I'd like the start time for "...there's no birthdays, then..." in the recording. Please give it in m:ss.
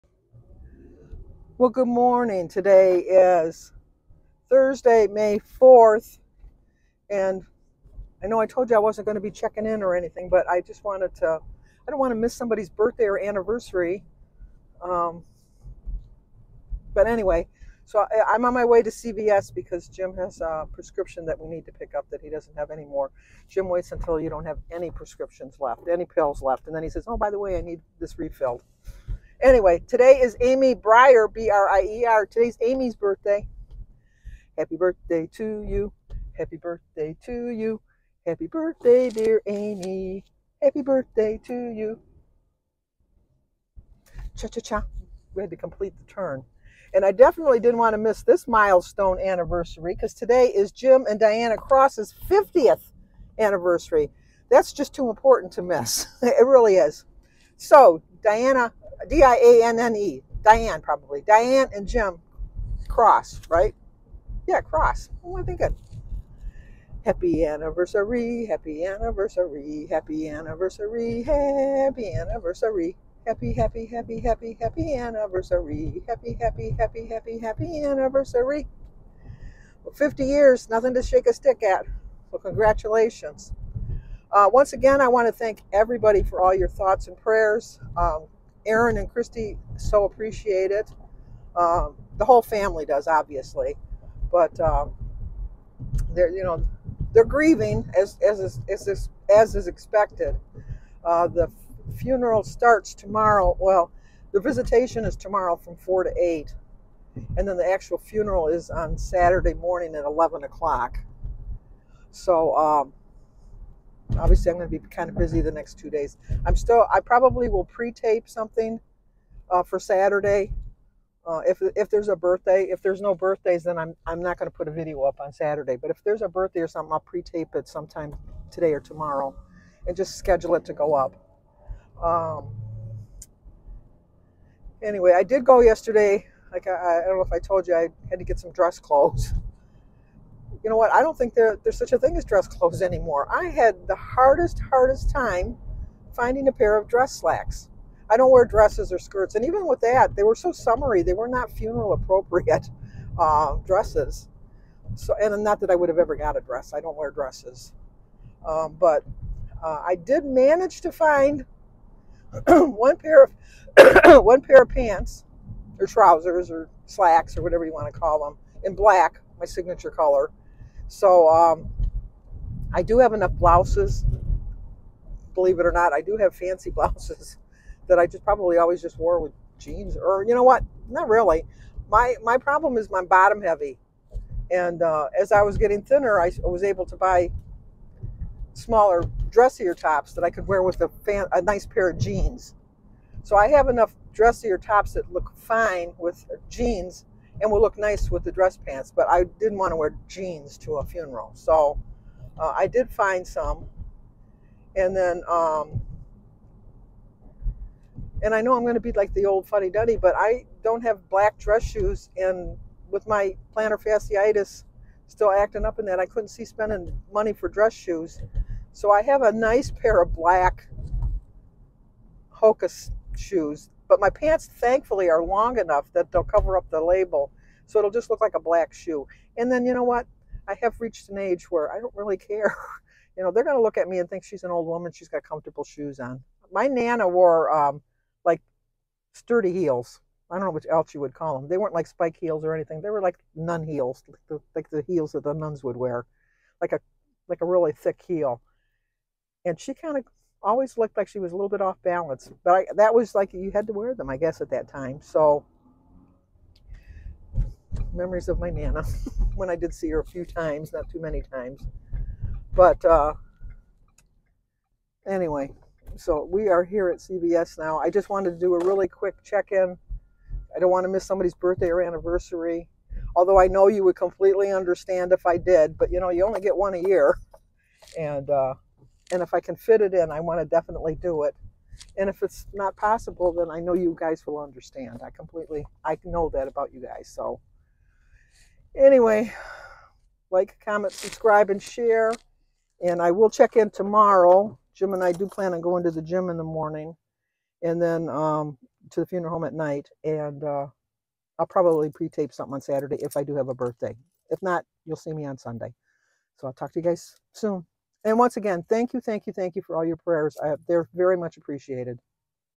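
2:02.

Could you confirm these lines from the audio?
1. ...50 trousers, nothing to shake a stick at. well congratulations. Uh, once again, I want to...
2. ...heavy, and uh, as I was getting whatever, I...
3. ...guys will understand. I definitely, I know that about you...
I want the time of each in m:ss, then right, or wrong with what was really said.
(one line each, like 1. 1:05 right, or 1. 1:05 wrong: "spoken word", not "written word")
1. 1:19 wrong: "years", not "trousers"
2. 3:03 wrong: "thinner", not "whatever"
3. 4:43 wrong: "completely", not "definitely".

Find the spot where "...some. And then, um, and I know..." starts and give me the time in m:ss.
3:23.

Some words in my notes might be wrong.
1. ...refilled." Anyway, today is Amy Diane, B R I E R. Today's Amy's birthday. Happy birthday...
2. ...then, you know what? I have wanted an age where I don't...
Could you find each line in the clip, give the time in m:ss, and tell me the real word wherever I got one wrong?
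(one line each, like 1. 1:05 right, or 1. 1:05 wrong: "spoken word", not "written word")
1. 0:28 wrong: "Brier", not "Diane"
2. 3:49 wrong: "reached", not "wanted".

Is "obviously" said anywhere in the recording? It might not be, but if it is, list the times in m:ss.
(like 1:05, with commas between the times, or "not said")
1:33, 1:54.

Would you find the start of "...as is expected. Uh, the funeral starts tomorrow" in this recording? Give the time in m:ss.
1:39.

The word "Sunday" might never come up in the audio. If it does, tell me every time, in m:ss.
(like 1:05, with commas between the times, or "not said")
5:05.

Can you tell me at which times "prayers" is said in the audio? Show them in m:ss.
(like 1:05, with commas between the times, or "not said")
1:27, 5:09.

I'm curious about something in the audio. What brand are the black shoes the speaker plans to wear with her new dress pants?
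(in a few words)
Hokas.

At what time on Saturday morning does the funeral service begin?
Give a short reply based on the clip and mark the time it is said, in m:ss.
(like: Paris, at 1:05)
11:00, at 1:50.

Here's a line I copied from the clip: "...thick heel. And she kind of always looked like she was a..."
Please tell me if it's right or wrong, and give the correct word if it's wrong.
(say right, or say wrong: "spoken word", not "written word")
right.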